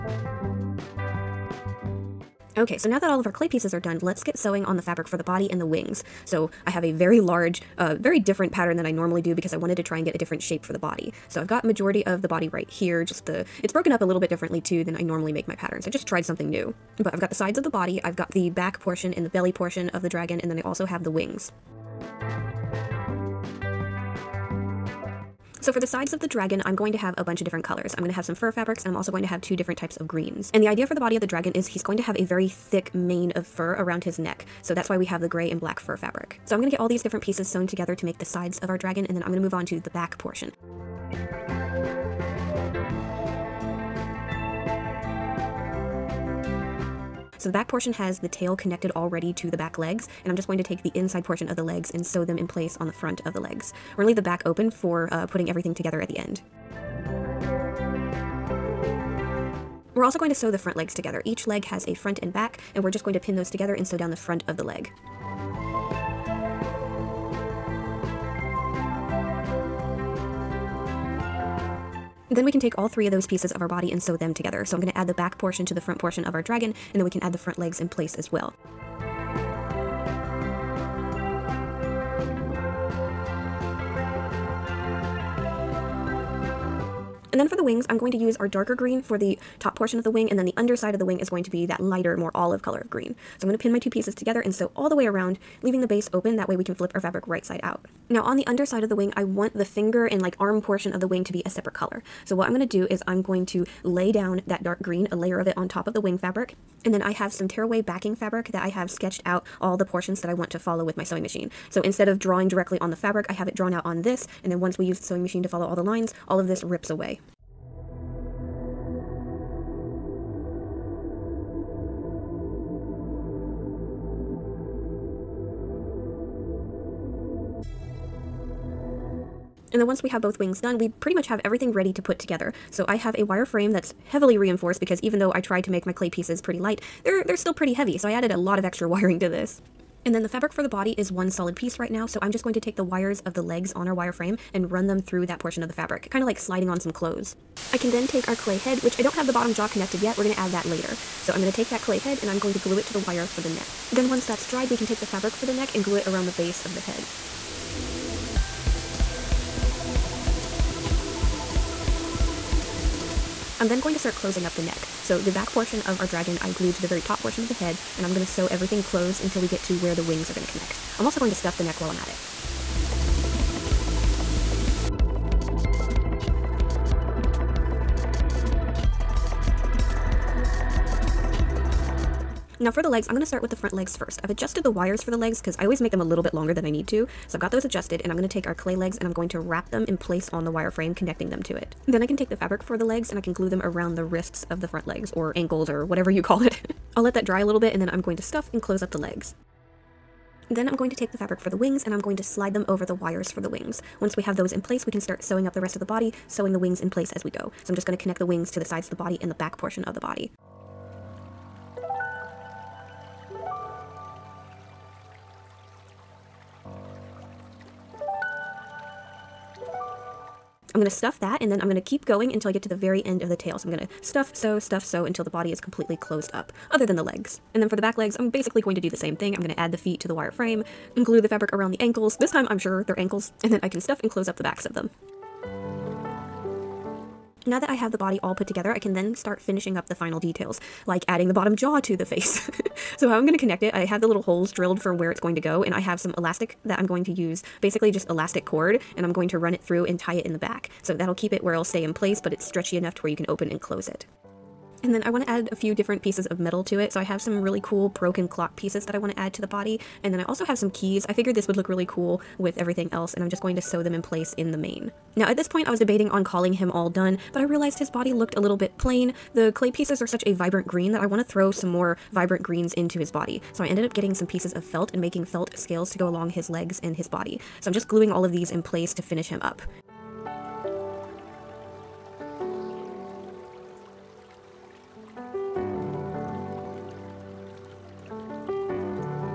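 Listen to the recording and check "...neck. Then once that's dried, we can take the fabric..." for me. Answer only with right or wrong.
right.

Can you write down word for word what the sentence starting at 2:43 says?
I'm then going to start closing up the neck.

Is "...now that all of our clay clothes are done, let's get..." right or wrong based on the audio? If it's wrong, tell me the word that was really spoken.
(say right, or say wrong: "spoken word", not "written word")
wrong: "pieces", not "clothes".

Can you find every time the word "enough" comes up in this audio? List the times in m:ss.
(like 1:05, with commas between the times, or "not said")
4:12.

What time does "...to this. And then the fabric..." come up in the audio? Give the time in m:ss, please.
2:19.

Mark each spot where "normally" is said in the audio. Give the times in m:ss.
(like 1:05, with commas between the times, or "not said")
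0:08, 0:15.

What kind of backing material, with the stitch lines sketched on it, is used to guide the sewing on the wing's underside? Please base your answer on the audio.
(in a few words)
tearaway backing fabric.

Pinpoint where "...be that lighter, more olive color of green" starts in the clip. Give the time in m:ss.
1:31.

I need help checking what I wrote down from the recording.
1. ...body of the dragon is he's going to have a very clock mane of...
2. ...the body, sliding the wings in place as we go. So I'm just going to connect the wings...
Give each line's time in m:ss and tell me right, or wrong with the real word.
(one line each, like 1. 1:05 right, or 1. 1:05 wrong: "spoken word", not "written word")
1. 0:30 wrong: "thick", not "clock"
2. 3:25 wrong: "sewing", not "sliding".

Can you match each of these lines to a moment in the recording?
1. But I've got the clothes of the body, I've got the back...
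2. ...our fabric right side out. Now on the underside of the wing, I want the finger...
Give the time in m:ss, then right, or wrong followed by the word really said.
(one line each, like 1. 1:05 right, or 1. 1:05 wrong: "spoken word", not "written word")
1. 0:17 wrong: "sides", not "clothes"
2. 1:36 right.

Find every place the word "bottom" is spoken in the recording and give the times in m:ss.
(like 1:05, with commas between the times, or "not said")
2:29, 4:01.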